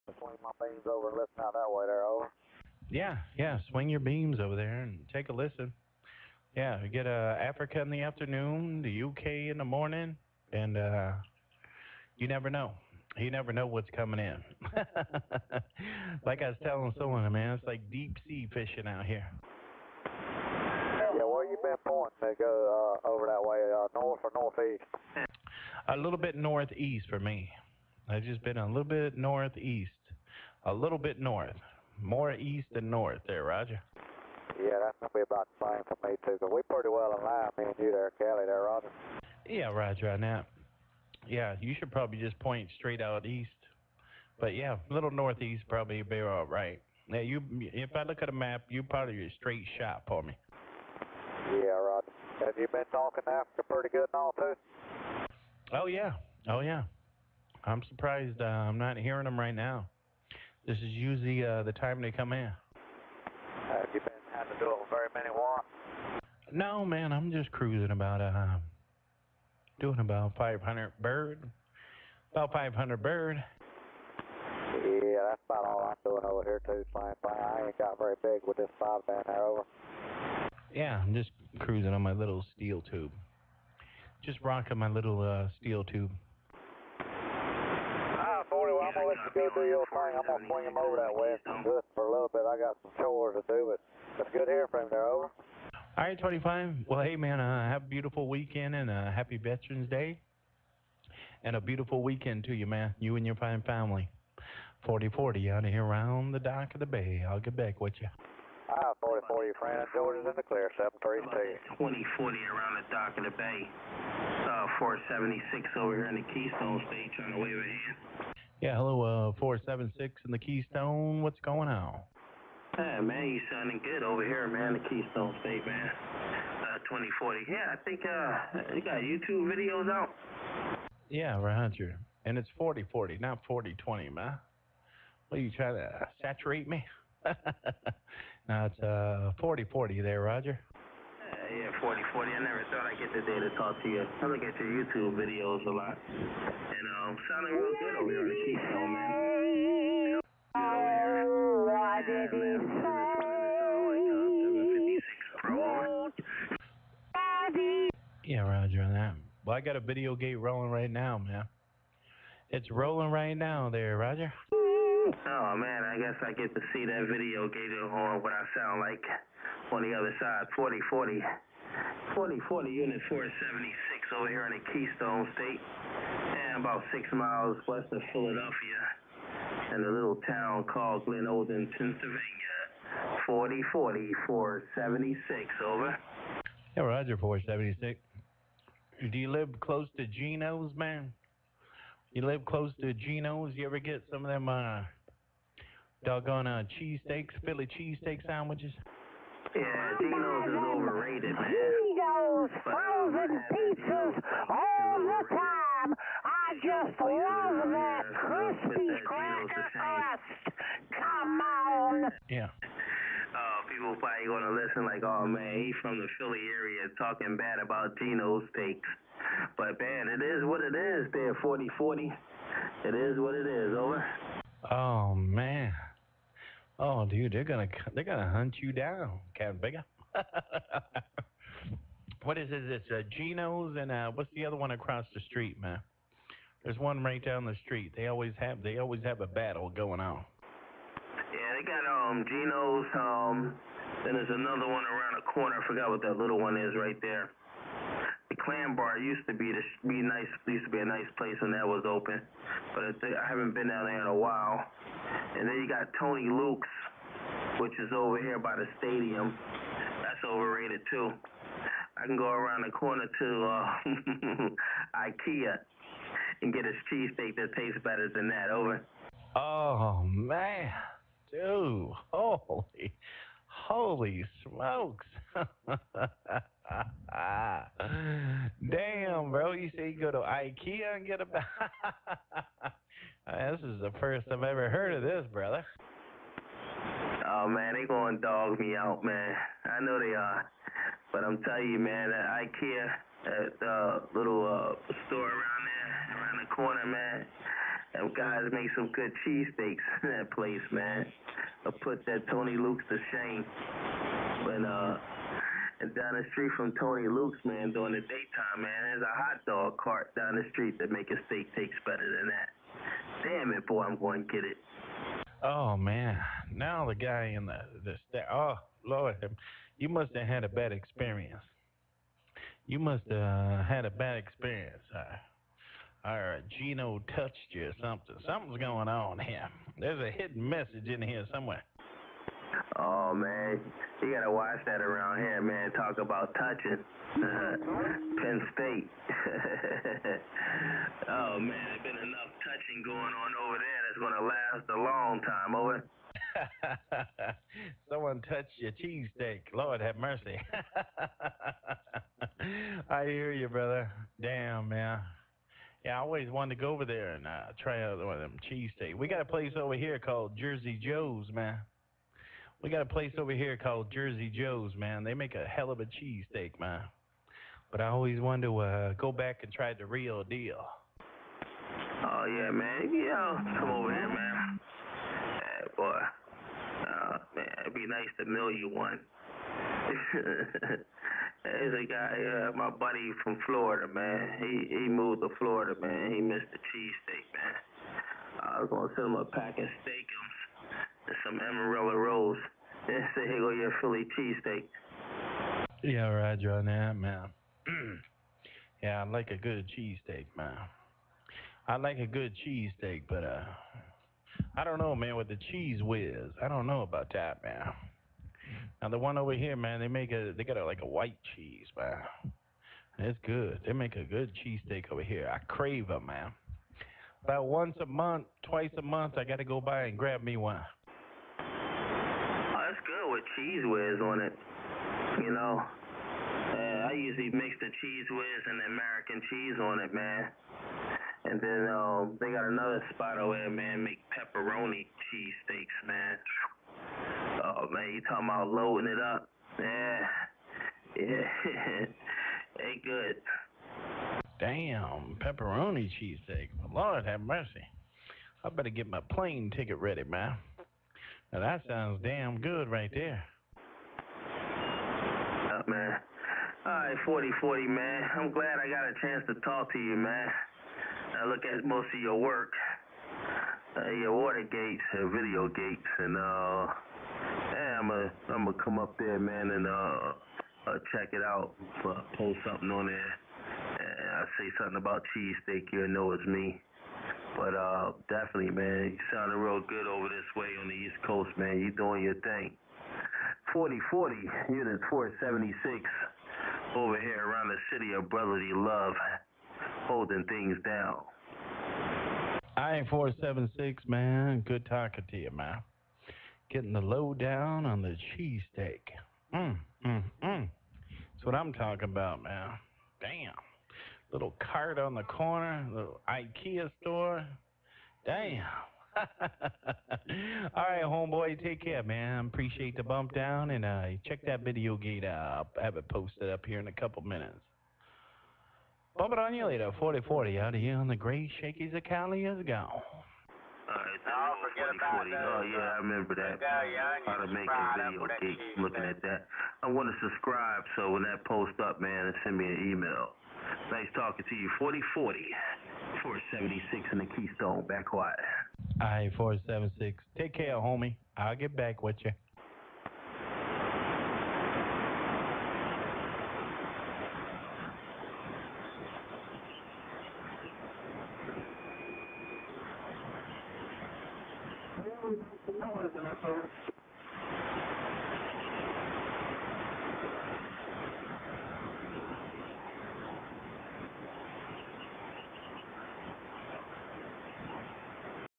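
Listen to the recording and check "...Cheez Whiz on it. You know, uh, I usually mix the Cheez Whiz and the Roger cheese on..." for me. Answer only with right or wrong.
wrong.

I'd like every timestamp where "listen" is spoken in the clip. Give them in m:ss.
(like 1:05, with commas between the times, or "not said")
0:01, 0:05, 3:34.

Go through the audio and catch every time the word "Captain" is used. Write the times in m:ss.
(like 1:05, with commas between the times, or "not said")
3:49.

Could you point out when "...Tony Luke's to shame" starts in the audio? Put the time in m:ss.
5:02.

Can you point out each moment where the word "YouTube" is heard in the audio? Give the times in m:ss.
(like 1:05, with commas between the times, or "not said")
2:09, 2:24.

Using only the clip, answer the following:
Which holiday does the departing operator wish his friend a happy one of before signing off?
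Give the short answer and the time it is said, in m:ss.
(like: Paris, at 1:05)
Veterans Day, at 1:39.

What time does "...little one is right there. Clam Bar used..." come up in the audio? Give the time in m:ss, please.
4:06.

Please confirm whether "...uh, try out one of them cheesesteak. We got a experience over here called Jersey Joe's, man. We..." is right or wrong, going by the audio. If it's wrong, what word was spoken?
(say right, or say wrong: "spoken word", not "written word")
wrong: "place", not "experience".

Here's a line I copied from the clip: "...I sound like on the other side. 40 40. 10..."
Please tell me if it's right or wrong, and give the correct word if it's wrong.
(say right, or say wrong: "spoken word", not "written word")
wrong: "40", not "10".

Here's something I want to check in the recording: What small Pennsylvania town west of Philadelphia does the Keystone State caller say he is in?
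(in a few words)
Glenolden.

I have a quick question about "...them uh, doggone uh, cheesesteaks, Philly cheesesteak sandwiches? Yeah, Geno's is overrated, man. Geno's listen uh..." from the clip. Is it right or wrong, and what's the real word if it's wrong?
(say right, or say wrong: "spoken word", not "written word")
wrong: "frozen", not "listen".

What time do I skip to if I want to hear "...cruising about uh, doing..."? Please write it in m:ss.
1:07.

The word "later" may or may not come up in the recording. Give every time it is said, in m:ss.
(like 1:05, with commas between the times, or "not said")
8:39.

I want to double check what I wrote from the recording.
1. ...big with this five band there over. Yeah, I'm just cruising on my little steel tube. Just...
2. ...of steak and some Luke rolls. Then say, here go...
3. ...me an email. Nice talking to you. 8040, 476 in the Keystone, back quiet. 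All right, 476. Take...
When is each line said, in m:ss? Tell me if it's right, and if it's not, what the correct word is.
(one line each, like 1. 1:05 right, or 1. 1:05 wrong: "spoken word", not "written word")
1. 1:18 right
2. 6:29 wrong: "Amarillo", not "Luke"
3. 8:52 wrong: "4040", not "8040".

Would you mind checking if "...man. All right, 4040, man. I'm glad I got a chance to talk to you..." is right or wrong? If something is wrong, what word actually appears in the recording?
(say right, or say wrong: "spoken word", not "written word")
right.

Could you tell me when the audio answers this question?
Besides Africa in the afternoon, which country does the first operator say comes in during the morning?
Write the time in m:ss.
0:08.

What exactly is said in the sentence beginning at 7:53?
And I say something about cheesesteak, you know it's me.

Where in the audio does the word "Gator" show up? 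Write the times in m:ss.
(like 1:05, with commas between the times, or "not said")
2:47.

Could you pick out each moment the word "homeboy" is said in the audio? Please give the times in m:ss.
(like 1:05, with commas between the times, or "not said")
8:30.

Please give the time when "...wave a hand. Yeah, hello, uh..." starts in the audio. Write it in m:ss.
1:57.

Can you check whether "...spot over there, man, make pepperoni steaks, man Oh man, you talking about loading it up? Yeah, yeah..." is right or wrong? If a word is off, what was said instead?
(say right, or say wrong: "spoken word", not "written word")
wrong: "cheesesteaks", not "steaks".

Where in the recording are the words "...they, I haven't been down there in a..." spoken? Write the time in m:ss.
4:13.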